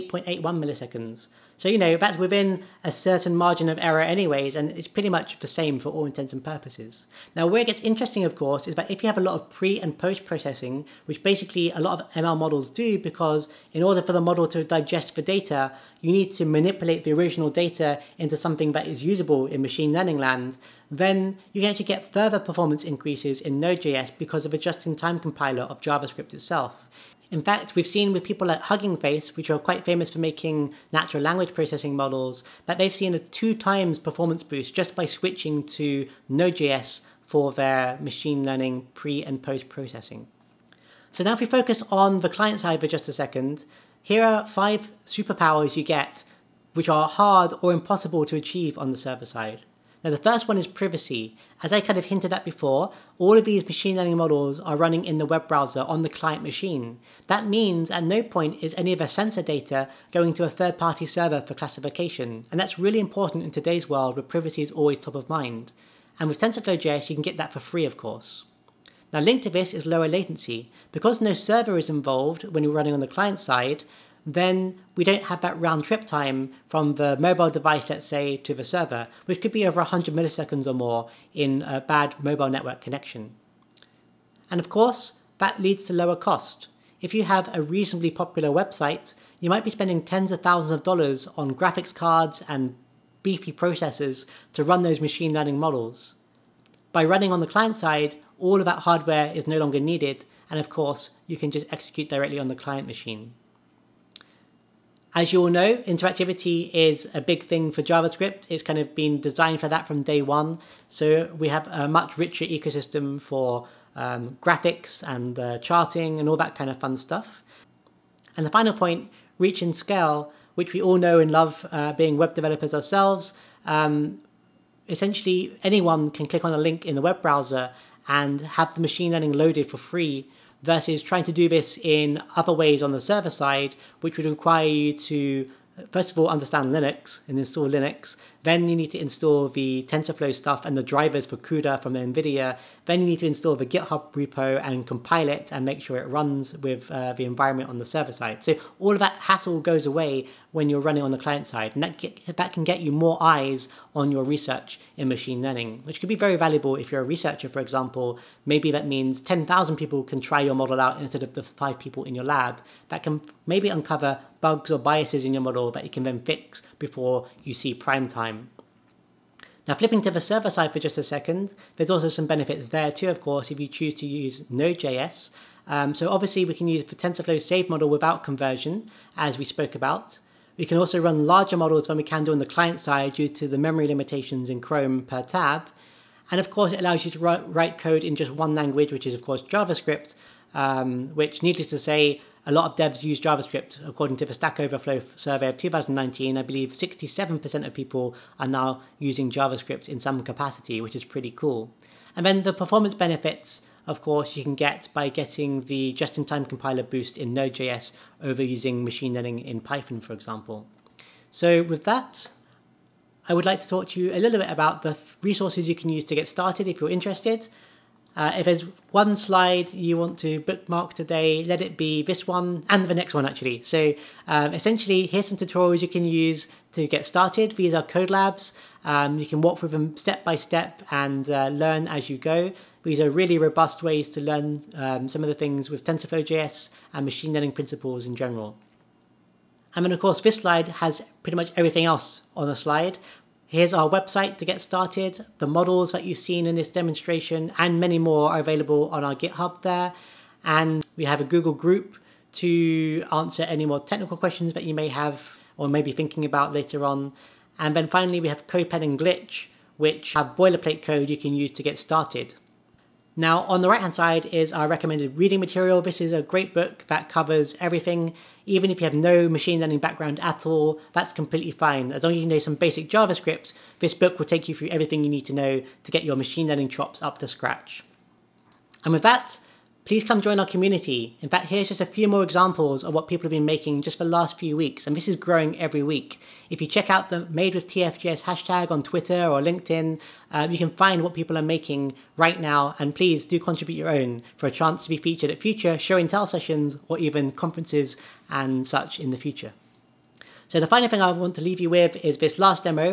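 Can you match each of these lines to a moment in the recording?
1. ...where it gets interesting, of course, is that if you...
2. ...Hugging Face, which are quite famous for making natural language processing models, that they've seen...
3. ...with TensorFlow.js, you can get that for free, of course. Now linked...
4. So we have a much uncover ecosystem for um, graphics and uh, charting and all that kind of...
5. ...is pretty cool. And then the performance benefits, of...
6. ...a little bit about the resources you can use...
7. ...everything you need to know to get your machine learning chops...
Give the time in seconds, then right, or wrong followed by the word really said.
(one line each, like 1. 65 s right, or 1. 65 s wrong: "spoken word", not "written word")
1. 7 s right
2. 28 s right
3. 66 s right
4. 110 s wrong: "richer", not "uncover"
5. 200 s right
6. 214 s right
7. 274 s right.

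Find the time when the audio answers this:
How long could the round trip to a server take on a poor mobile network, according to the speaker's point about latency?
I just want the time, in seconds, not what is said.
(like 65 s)
79 s.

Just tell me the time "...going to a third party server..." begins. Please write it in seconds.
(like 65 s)
60 s.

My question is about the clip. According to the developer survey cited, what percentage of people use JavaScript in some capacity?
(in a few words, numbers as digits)
67%.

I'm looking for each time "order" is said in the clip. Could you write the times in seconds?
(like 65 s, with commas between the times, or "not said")
13 s.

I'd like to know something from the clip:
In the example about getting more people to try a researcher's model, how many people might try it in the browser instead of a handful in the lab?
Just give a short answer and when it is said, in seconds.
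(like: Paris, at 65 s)
10,000, at 159 s.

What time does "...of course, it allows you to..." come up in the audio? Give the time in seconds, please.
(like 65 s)
186 s.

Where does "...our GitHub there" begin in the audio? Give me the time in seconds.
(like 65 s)
249 s.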